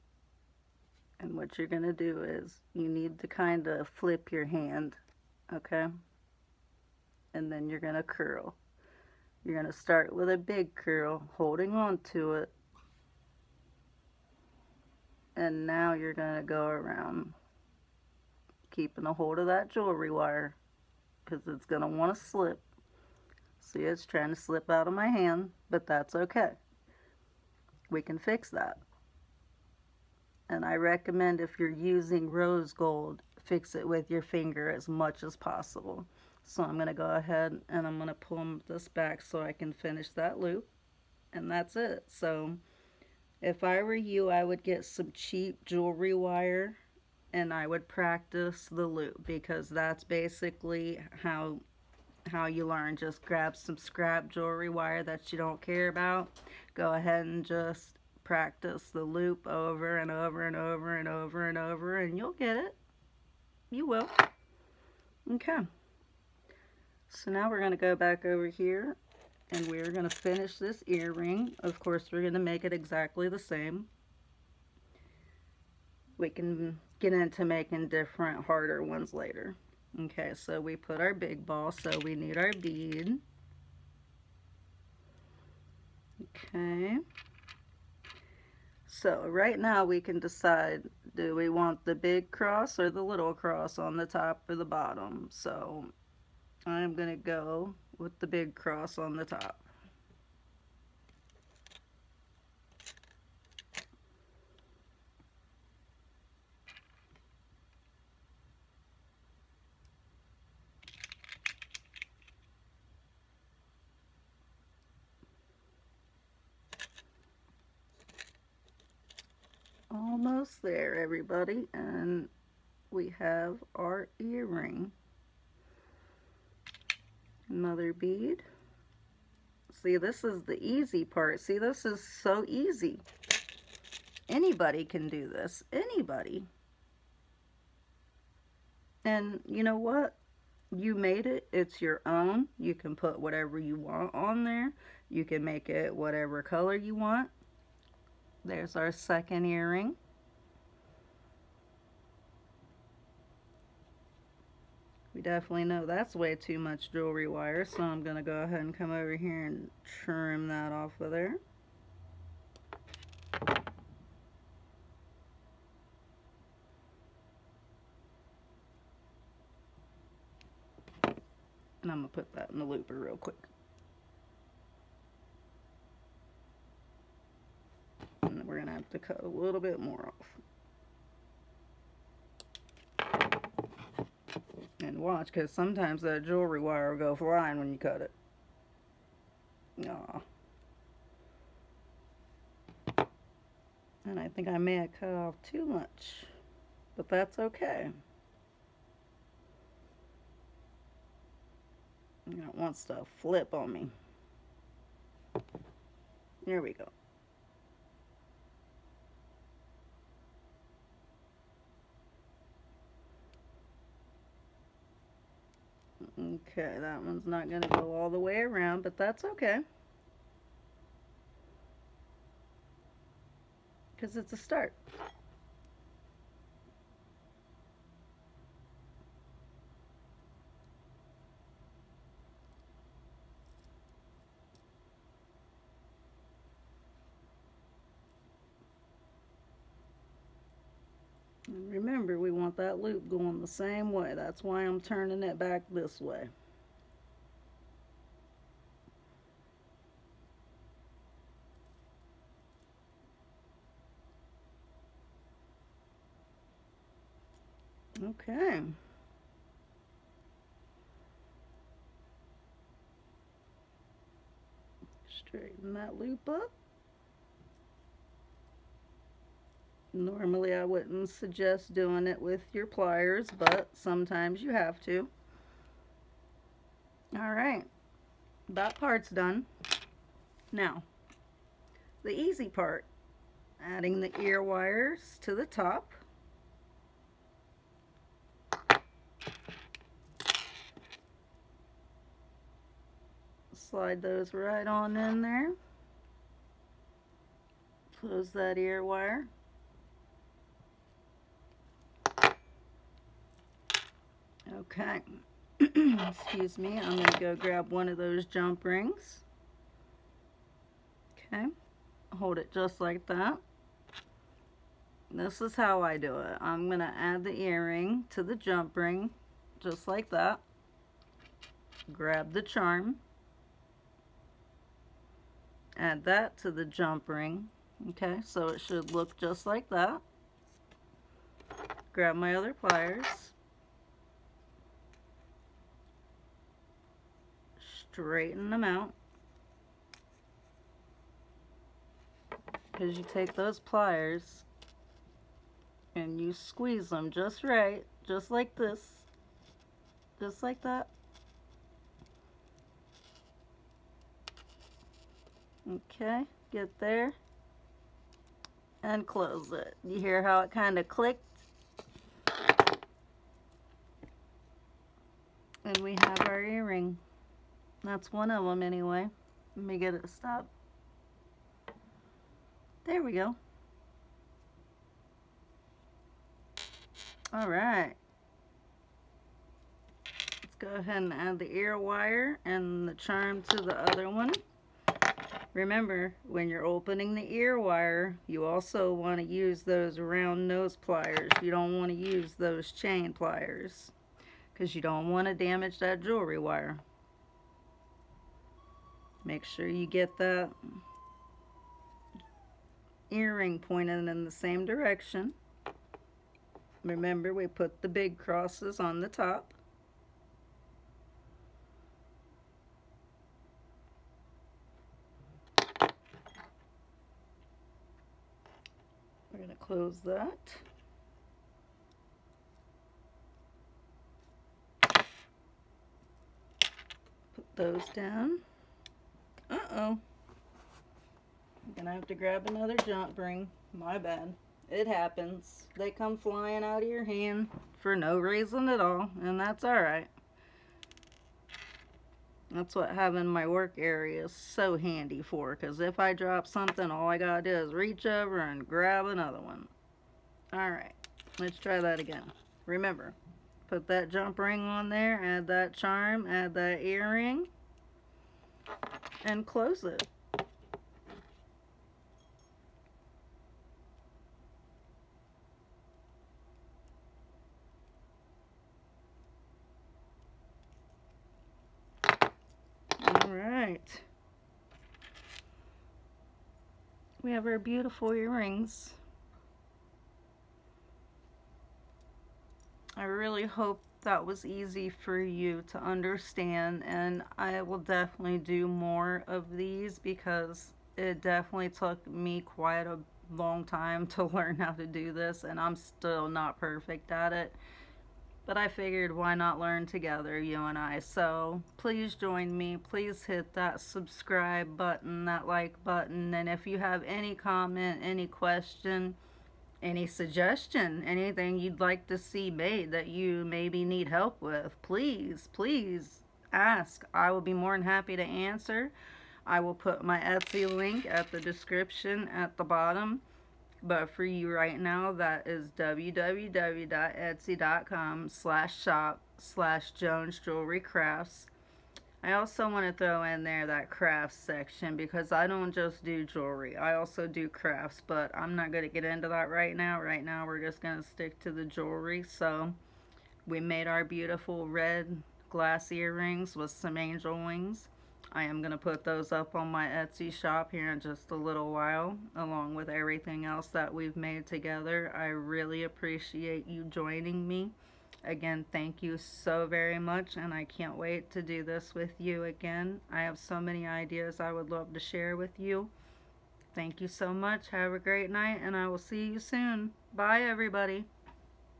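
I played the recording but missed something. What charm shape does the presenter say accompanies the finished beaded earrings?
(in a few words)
angel wings.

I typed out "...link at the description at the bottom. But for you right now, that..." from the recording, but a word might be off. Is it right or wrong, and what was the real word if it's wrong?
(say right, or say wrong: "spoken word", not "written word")
right.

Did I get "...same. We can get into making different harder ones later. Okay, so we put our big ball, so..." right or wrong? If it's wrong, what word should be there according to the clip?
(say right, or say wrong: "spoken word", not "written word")
right.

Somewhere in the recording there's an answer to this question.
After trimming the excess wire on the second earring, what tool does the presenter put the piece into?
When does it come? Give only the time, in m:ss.
2:52.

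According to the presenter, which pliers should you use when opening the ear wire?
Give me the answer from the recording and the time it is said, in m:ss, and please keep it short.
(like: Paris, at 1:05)
round nose pliers, at 6:29.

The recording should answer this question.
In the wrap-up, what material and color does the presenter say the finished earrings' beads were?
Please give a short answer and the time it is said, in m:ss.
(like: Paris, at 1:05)
red glass, at 9:04.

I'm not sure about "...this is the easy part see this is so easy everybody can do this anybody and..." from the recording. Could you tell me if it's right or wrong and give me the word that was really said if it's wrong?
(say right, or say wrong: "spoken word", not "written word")
wrong: "anybody", not "everybody".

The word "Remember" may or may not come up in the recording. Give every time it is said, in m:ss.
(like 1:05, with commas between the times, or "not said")
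6:25, 6:46, 7:32.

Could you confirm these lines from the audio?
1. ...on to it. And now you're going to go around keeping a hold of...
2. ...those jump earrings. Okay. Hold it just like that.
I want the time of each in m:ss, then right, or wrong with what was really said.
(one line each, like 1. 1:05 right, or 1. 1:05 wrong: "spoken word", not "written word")
1. 0:11 right
2. 5:07 wrong: "rings", not "earrings".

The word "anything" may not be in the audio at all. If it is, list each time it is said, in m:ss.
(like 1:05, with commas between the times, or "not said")
8:31.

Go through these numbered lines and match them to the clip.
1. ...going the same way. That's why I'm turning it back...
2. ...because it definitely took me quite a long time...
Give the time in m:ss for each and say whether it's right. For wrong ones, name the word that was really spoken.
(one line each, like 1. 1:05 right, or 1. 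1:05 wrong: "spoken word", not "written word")
1. 4:03 right
2. 8:09 right.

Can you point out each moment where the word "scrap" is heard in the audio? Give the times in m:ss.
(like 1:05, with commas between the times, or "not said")
0:53.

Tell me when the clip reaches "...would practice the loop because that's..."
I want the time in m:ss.
0:47.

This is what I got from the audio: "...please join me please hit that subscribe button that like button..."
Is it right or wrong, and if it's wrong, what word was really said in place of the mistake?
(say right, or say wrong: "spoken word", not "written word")
right.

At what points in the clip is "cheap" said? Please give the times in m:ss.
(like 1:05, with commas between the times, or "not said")
0:45.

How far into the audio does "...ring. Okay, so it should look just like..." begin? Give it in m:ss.
5:27.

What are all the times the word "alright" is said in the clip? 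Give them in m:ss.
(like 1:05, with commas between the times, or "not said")
4:37, 7:19, 7:30.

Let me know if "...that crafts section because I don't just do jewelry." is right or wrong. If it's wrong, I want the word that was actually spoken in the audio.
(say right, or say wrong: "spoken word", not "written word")
right.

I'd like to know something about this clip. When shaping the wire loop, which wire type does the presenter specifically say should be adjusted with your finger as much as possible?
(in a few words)
rose gold.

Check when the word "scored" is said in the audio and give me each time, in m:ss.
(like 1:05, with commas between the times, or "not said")
not said.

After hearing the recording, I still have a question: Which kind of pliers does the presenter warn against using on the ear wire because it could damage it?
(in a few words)
chain pliers.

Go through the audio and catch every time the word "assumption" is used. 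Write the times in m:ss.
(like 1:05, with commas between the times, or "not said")
not said.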